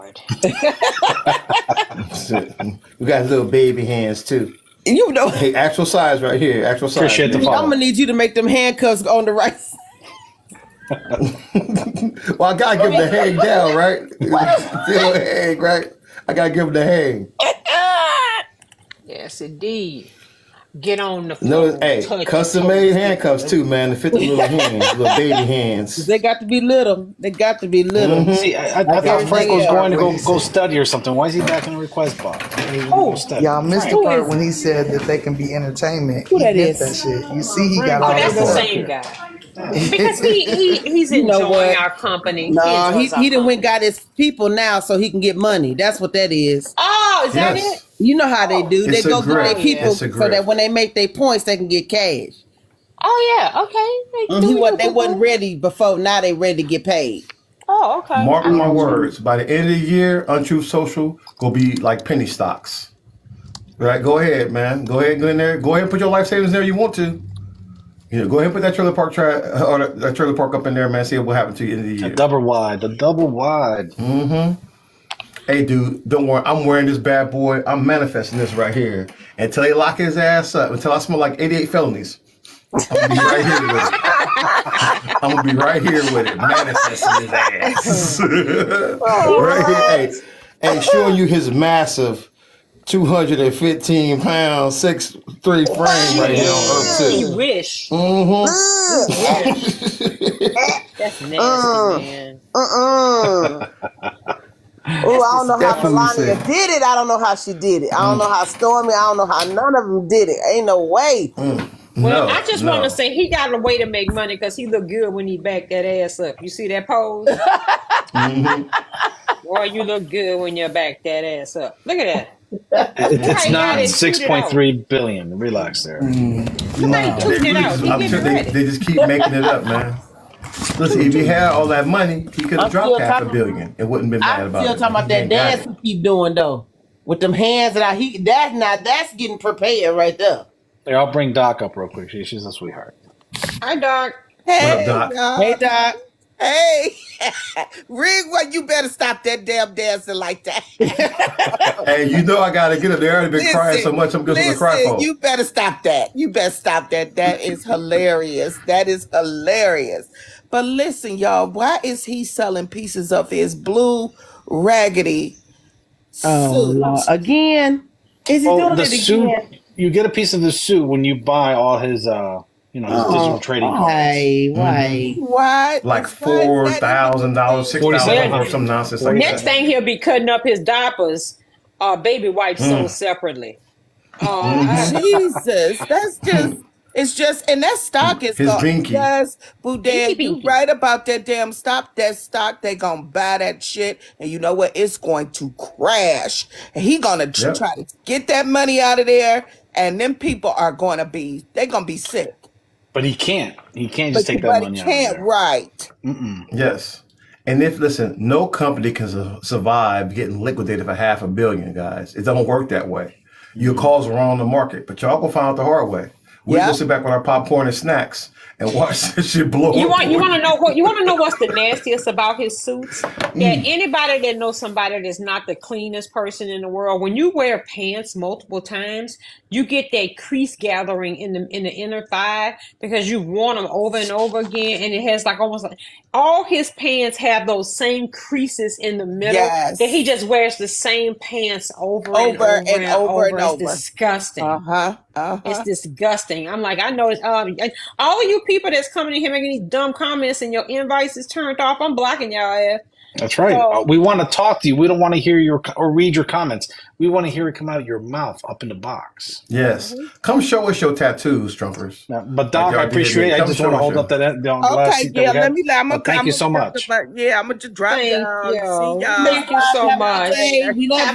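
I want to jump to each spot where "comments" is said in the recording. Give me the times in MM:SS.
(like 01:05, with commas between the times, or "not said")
04:09, 04:16.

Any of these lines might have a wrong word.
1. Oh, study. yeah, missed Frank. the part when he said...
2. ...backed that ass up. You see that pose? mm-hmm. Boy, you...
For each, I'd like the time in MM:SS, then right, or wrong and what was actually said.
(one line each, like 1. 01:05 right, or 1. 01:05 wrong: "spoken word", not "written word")
1. 00:32 right
2. 01:55 right.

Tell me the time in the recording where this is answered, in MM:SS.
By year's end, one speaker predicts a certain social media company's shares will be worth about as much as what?
01:02.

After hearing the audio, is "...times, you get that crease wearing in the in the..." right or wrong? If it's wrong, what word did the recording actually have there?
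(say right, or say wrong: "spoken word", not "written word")
wrong: "gathering", not "wearing".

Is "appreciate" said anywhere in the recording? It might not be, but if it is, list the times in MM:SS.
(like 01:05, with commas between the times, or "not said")
00:07, 04:22.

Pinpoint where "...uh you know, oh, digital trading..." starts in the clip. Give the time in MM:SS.
02:52.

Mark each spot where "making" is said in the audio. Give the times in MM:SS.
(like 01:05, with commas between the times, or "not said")
02:09, 04:09.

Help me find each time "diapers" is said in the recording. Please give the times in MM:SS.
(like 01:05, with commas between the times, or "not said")
03:00.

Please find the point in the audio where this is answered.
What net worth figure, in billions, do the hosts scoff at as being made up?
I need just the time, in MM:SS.
02:03.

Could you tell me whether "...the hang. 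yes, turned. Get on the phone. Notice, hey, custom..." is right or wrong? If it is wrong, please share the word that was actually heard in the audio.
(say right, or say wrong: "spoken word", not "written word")
wrong: "indeed", not "turned".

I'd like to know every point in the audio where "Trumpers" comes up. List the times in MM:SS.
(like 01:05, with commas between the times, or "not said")
04:21.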